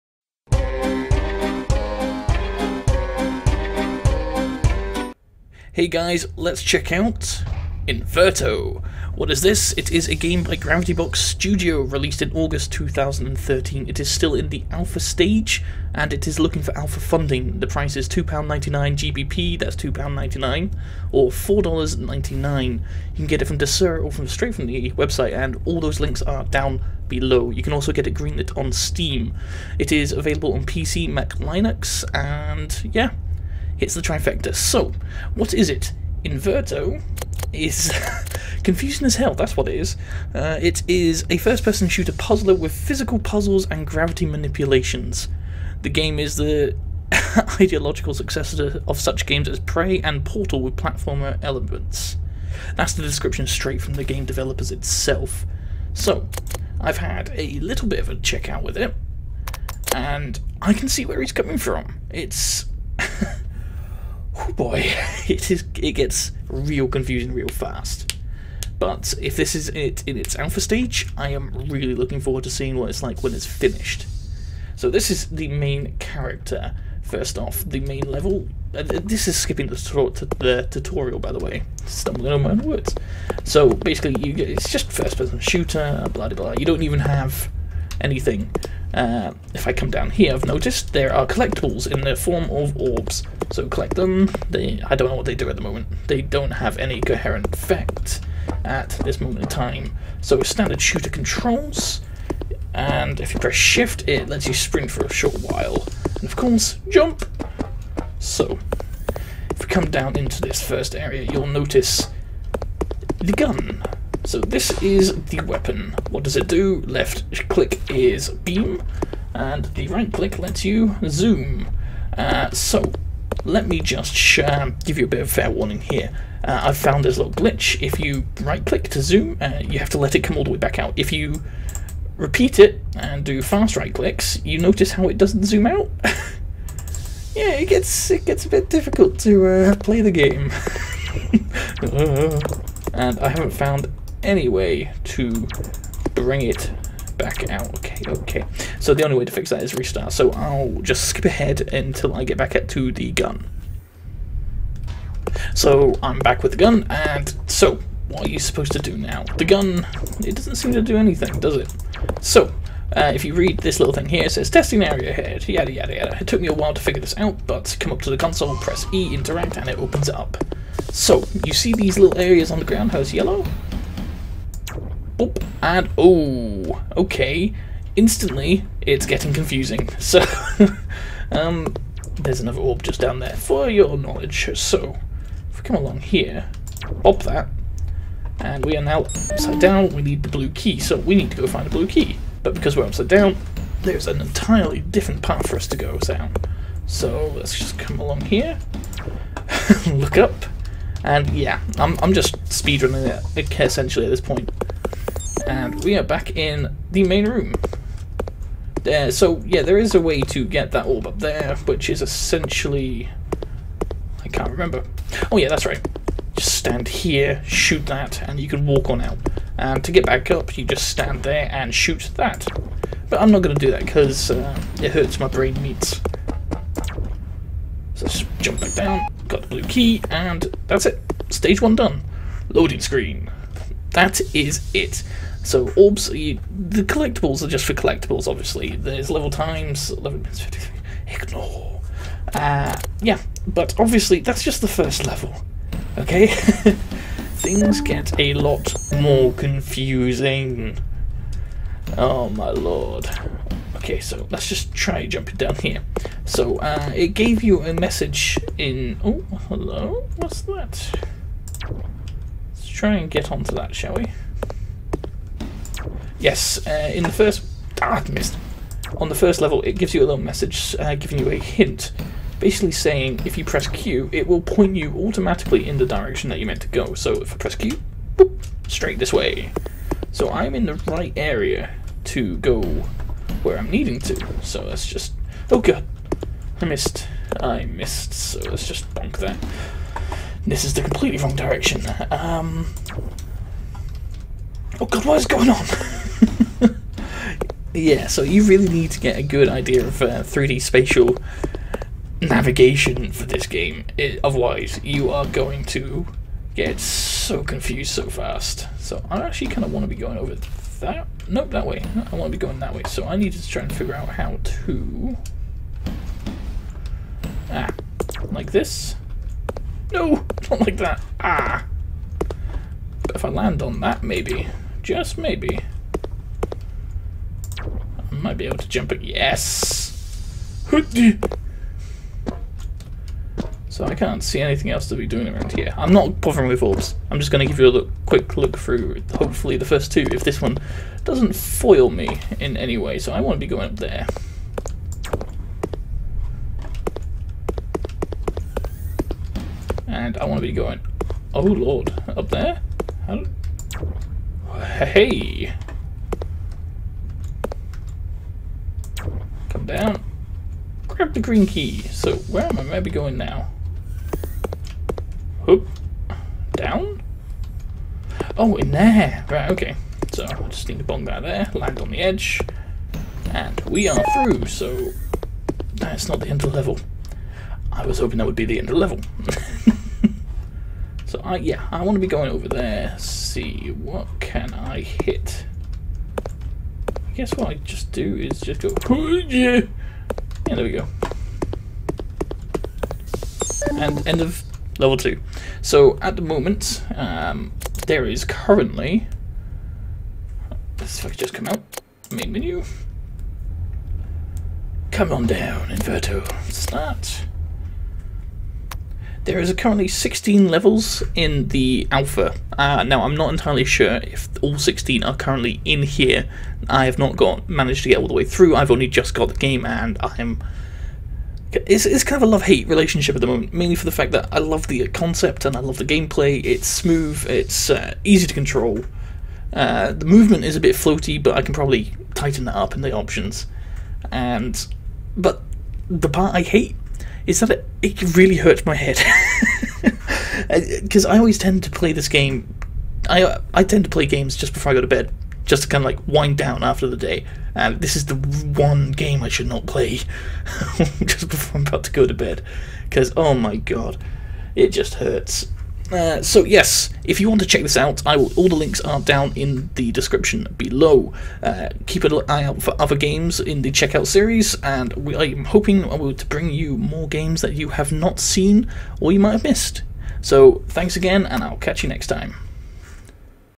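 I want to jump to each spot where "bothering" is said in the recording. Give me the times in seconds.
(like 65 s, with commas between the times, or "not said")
336 s.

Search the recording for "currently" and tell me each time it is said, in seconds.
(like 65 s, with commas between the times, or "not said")
398 s, 409 s, 415 s.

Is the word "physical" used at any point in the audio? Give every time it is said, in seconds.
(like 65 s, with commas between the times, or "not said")
42 s.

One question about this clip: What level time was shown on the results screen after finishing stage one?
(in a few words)
11 minutes 53.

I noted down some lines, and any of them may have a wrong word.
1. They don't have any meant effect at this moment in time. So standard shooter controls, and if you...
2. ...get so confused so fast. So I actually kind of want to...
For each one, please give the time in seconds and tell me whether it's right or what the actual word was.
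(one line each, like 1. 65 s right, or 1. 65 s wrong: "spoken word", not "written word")
1. 96 s wrong: "coherent", not "meant"
2. 306 s right.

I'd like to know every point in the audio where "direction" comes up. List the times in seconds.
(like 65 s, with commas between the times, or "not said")
275 s, 291 s.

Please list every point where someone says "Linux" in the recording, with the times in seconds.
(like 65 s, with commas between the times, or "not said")
31 s.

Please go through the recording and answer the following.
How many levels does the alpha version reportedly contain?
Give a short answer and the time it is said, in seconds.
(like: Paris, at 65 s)
16, at 409 s.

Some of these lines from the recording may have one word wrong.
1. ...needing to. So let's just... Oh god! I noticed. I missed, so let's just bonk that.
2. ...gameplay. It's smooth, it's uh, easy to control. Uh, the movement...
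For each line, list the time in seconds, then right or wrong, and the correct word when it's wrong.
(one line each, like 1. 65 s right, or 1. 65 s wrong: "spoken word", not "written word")
1. 283 s wrong: "missed", not "noticed"
2. 425 s right.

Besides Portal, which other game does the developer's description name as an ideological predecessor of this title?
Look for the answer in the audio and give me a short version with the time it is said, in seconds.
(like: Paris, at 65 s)
Prey, at 49 s.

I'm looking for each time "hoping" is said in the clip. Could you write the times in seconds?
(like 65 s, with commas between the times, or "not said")
377 s, 465 s.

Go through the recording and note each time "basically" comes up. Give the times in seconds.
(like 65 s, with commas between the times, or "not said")
83 s, 272 s.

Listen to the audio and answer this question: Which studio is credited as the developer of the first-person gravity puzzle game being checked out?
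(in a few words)
Gravity Box Studio.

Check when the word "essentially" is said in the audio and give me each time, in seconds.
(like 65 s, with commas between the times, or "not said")
203 s, 212 s.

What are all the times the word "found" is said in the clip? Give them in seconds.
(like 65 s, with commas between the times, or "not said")
126 s, 143 s.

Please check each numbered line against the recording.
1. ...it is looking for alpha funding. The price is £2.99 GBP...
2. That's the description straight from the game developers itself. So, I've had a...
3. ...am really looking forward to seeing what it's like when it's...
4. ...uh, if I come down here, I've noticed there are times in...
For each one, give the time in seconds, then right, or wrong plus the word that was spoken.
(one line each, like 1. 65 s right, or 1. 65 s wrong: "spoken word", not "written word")
1. 16 s right
2. 52 s right
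3. 71 s right
4. 88 s wrong: "collectibles", not "times".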